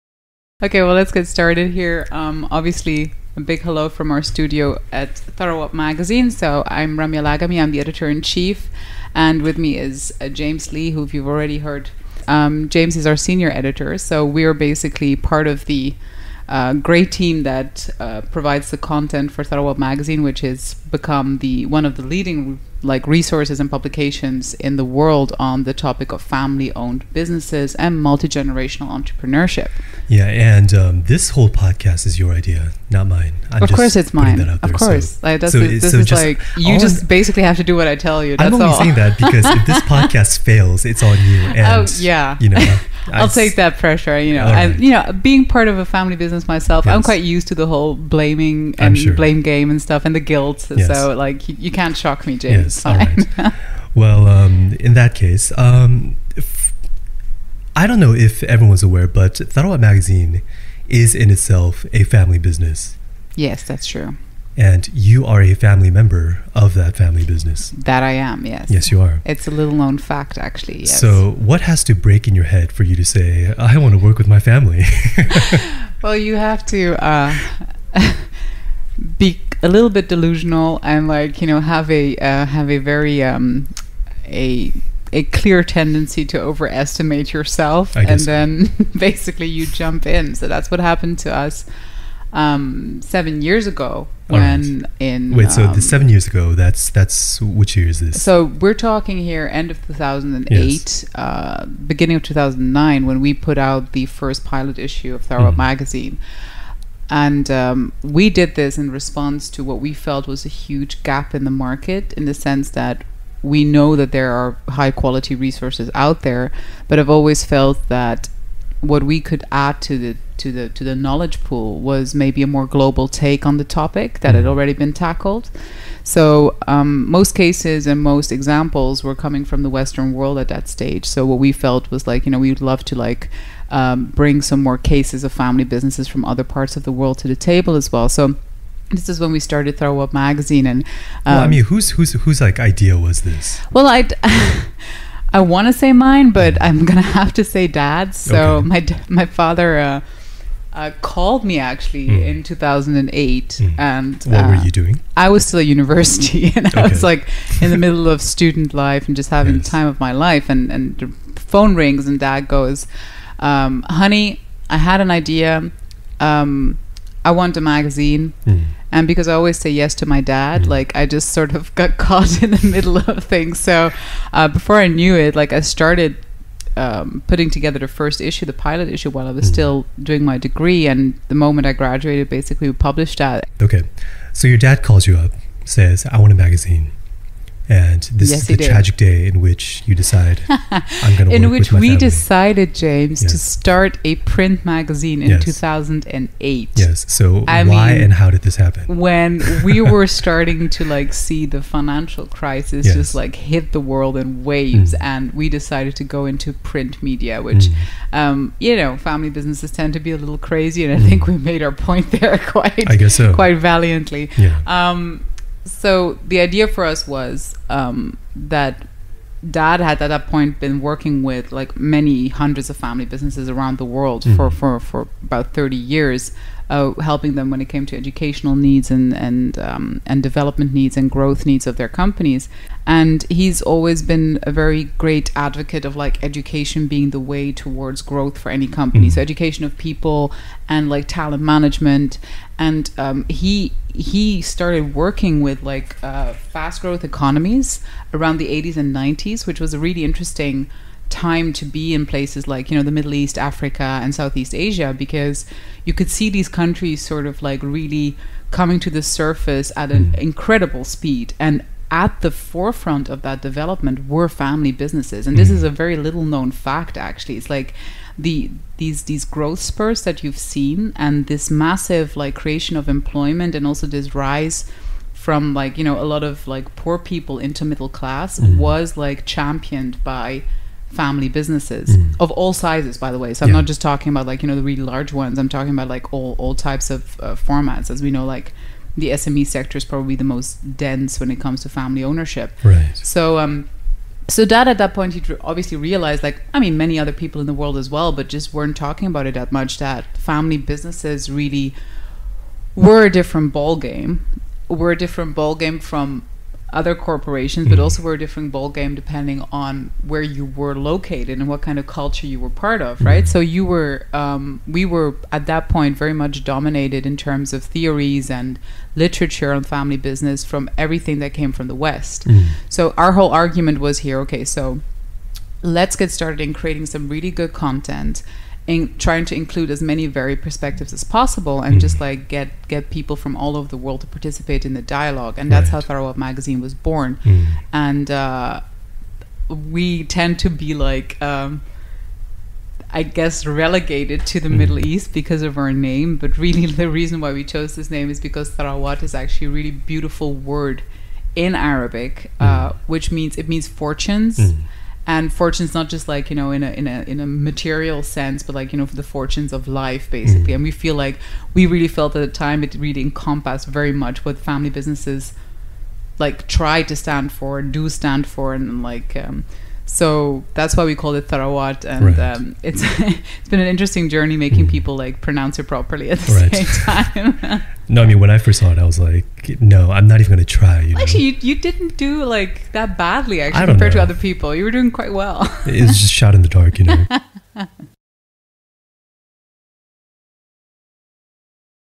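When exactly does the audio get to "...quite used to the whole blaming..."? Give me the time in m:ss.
0:47.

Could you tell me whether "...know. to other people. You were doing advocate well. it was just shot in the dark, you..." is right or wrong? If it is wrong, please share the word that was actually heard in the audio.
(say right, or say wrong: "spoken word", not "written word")
wrong: "quite", not "advocate".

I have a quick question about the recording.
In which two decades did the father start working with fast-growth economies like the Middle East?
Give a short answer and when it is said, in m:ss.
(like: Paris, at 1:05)
80s and 90s, at 4:08.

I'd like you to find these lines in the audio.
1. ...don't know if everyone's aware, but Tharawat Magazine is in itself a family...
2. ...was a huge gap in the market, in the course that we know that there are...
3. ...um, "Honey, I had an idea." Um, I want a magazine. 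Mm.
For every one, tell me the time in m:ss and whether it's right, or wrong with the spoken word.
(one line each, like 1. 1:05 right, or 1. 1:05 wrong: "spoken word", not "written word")
1. 0:57 right
2. 1:50 wrong: "sense", not "course"
3. 2:43 right.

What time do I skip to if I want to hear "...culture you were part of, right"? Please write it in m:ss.
5:11.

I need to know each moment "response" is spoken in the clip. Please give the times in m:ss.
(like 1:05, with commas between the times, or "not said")
1:48.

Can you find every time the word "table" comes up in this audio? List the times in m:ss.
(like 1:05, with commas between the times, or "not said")
2:17.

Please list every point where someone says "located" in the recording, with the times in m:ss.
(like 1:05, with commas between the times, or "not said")
5:10.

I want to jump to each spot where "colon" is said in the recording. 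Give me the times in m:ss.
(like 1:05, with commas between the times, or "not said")
not said.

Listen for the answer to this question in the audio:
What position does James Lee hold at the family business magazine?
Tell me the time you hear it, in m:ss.
0:13.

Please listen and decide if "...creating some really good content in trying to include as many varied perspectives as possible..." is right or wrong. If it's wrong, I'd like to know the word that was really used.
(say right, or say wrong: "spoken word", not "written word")
right.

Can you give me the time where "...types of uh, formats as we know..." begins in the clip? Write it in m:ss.
4:46.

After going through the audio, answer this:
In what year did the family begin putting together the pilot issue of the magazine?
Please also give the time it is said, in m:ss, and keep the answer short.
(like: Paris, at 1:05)
2008, at 1:39.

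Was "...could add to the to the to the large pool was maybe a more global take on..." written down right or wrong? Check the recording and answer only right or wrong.
wrong.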